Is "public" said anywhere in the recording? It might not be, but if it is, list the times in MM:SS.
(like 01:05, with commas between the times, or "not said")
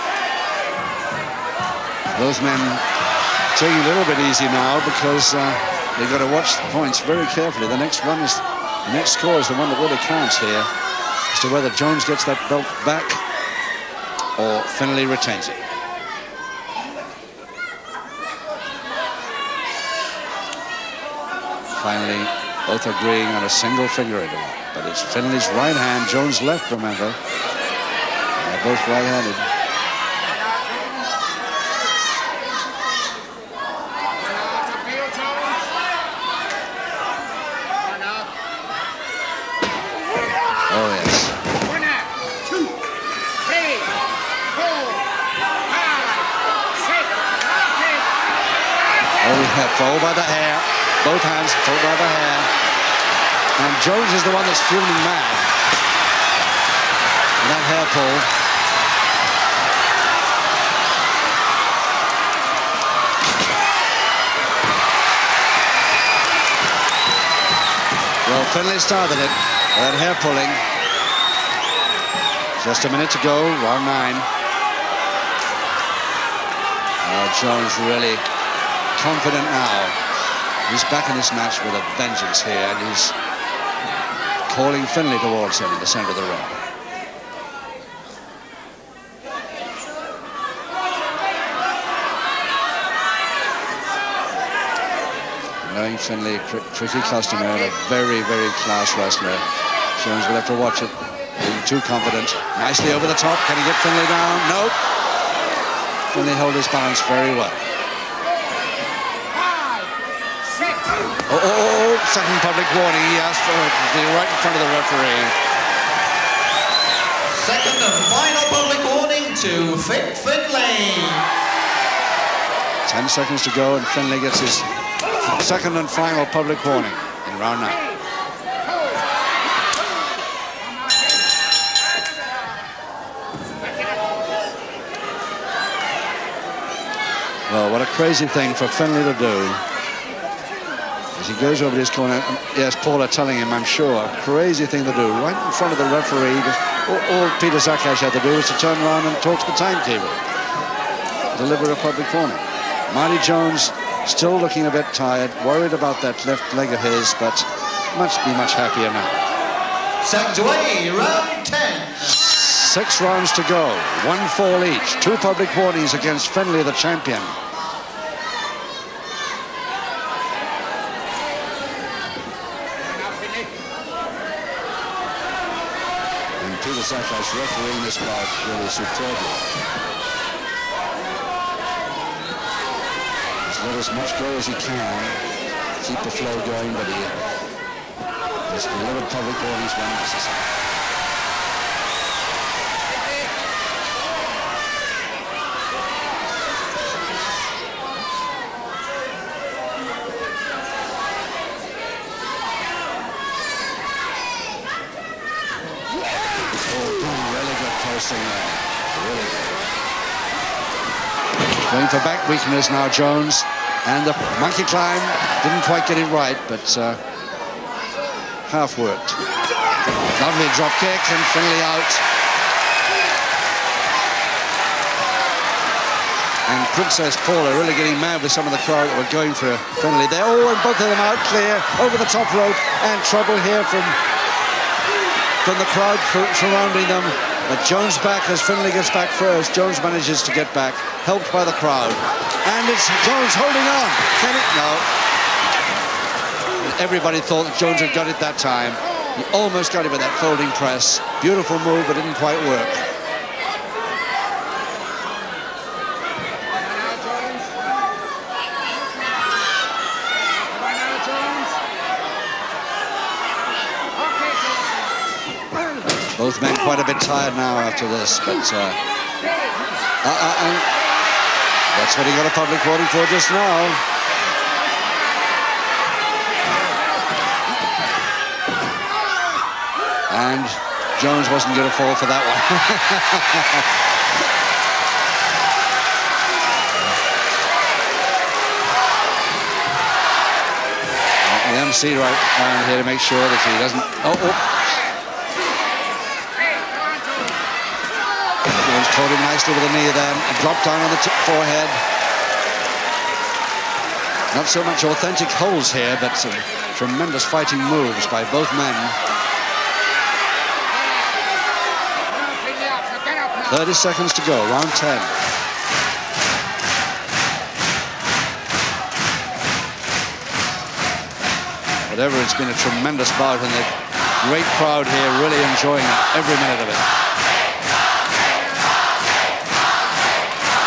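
01:52, 01:58, 02:06, 02:31, 02:45, 03:09, 04:32.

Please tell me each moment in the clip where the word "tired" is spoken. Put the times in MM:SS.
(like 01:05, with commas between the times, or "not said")
02:34, 04:27.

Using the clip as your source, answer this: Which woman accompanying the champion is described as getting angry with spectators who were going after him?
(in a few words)
Princess Paula.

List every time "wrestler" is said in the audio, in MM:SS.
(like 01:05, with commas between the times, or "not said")
01:38.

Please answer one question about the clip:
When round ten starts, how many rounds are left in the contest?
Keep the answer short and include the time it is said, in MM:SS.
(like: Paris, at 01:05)
6, at 02:42.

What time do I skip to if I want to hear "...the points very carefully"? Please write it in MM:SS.
00:06.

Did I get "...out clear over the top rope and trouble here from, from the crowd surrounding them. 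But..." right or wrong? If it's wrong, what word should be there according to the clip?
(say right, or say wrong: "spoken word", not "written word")
right.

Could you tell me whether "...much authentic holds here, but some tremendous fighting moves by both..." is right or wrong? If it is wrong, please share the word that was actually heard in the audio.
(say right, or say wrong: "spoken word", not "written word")
right.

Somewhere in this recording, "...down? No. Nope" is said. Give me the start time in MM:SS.
01:44.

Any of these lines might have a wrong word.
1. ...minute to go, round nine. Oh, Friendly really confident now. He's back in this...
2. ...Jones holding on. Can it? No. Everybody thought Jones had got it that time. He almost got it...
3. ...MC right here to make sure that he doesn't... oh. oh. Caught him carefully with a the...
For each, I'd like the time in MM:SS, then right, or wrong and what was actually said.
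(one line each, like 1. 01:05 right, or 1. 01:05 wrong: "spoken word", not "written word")
1. 01:12 wrong: "Jones", not "Friendly"
2. 04:03 right
3. 04:51 wrong: "nicely", not "carefully".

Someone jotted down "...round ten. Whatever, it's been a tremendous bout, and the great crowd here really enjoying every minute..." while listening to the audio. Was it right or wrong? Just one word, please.
right.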